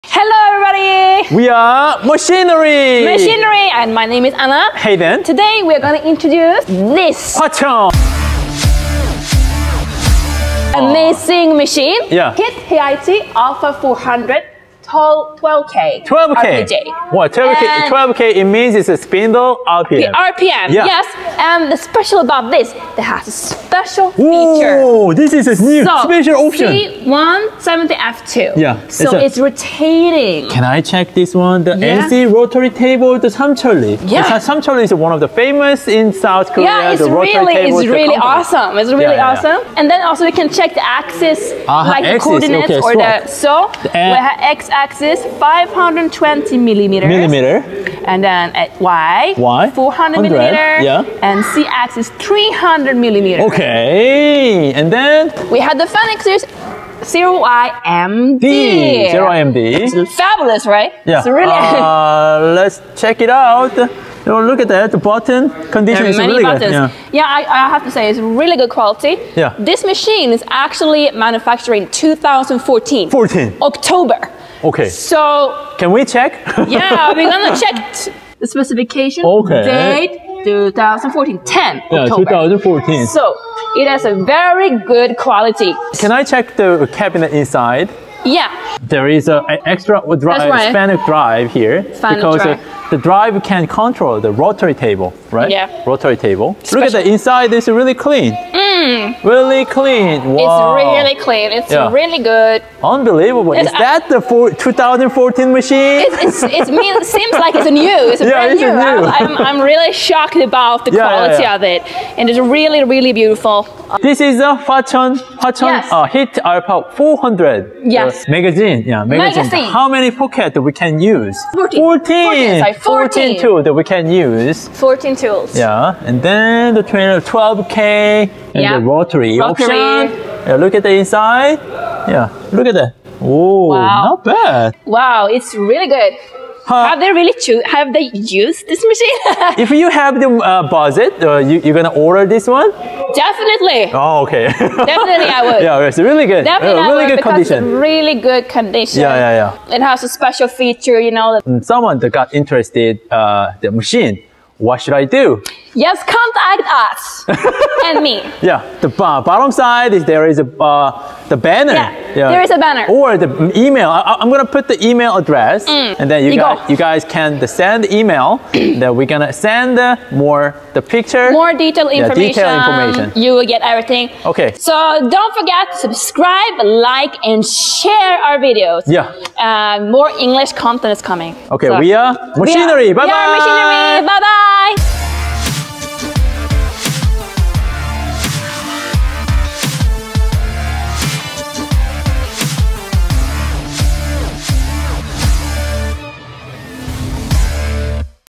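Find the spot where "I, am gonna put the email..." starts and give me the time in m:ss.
2:43.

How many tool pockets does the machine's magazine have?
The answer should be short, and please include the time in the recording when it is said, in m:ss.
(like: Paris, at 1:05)
14, at 1:59.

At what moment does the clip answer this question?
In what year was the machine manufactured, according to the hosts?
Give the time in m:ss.
1:09.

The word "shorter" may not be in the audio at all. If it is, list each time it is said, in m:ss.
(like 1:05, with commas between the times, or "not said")
not said.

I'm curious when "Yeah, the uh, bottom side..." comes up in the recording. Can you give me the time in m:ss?
2:38.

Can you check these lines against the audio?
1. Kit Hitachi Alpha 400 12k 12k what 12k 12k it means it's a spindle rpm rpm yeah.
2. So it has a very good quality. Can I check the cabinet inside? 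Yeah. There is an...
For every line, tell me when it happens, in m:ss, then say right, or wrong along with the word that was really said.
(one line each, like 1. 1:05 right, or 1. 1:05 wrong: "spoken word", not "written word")
1. 0:12 right
2. 1:23 right.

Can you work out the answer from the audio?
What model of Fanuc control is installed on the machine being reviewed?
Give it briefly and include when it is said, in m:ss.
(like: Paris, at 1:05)
0IMD, at 0:55.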